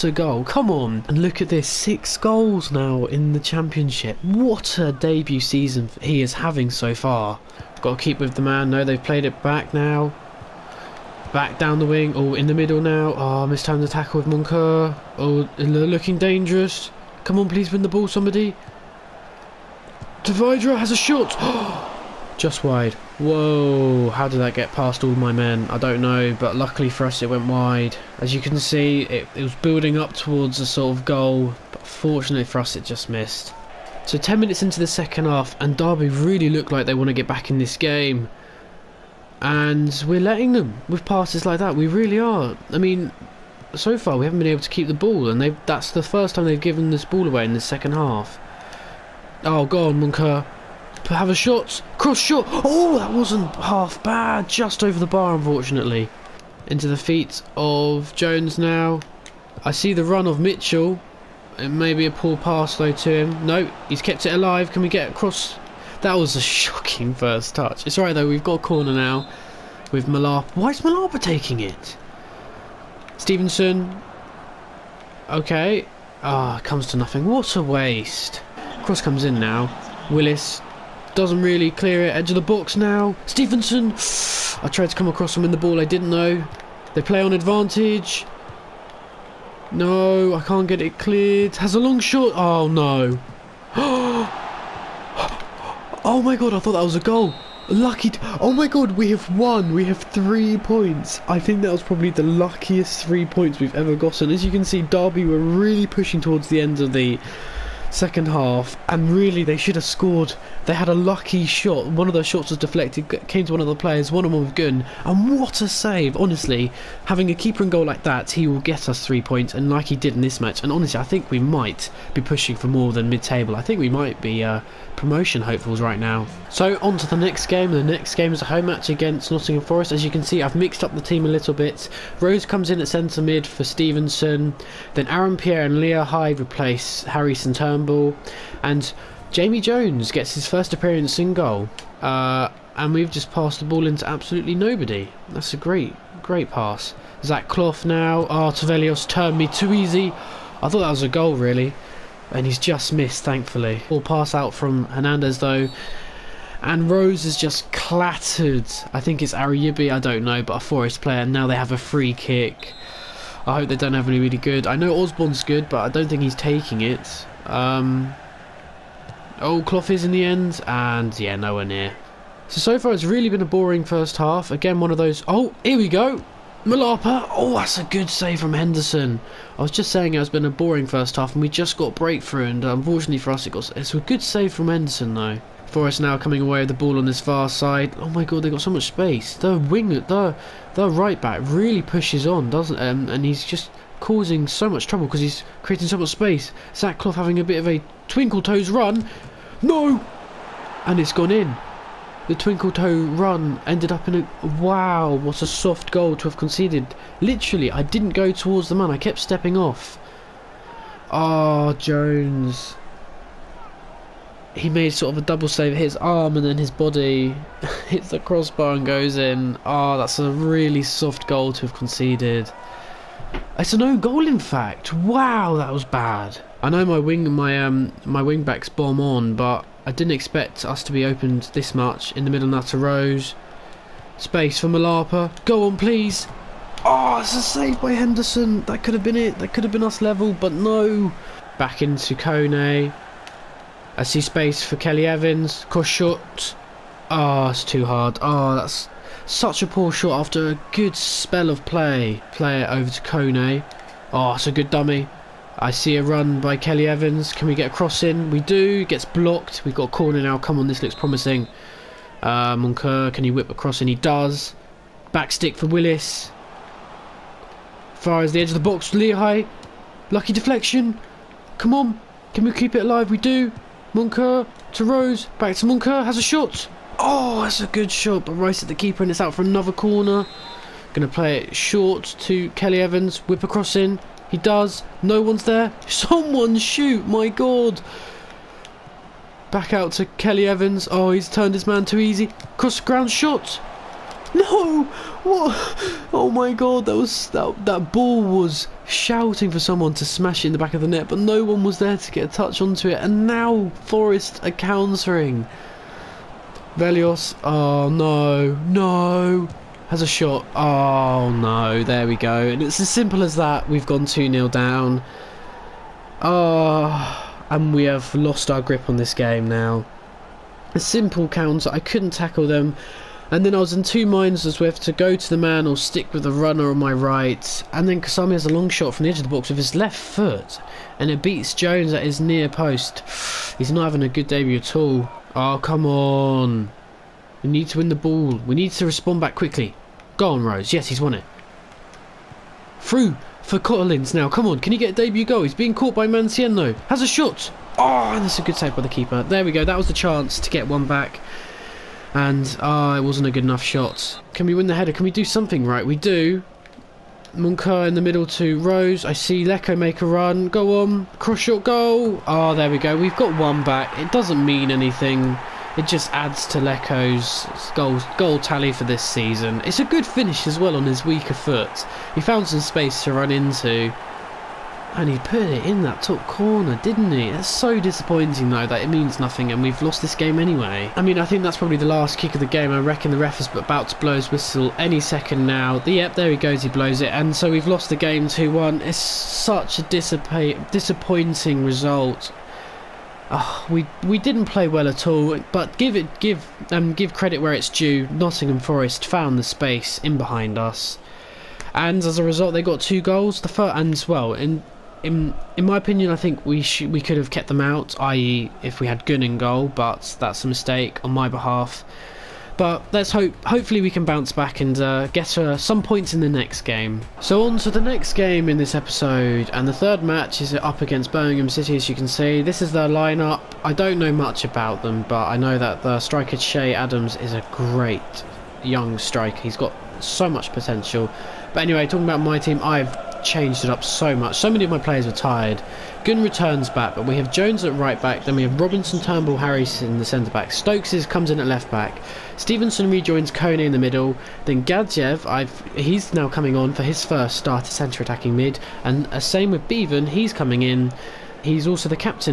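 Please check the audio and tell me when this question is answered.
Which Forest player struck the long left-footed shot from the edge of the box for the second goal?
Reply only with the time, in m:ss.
5:28.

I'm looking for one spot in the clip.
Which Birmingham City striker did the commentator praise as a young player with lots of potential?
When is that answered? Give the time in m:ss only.
7:06.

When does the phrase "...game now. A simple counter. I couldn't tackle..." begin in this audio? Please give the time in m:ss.
5:19.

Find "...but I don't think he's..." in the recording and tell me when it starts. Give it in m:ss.
2:45.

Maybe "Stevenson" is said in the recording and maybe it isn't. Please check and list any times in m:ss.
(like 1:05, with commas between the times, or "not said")
1:13, 1:23, 2:13, 7:22.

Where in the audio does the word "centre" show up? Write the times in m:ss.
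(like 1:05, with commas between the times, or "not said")
2:12, 7:20, 7:27.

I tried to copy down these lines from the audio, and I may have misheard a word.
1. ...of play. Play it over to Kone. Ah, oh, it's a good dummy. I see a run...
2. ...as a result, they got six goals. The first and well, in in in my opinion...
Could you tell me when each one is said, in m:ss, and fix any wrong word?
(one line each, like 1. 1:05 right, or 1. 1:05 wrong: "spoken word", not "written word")
1. 4:11 right
2. 6:42 wrong: "two", not "six".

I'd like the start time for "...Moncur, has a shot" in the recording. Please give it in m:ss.
4:35.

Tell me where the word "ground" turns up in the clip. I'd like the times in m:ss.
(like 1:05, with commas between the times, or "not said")
4:52.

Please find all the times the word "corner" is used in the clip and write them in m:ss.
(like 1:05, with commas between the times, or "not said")
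1:08, 4:19, 4:39, 6:16.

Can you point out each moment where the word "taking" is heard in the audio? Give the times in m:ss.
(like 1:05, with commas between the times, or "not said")
1:11, 2:46.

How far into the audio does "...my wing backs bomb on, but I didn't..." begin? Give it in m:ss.
3:48.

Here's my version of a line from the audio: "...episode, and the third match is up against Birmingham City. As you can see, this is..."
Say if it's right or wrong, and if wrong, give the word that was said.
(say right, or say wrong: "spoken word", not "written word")
right.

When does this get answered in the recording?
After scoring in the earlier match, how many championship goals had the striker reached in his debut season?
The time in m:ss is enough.
0:01.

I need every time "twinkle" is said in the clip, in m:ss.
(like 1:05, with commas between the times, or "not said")
3:18, 3:22.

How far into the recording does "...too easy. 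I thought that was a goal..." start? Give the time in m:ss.
2:29.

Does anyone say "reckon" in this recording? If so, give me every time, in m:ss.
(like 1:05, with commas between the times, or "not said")
6:22.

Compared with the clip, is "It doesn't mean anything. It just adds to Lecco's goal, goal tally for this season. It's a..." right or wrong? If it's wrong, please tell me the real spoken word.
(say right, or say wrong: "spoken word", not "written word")
right.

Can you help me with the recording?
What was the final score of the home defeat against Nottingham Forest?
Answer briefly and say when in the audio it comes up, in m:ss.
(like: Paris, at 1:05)
2-1, at 6:28.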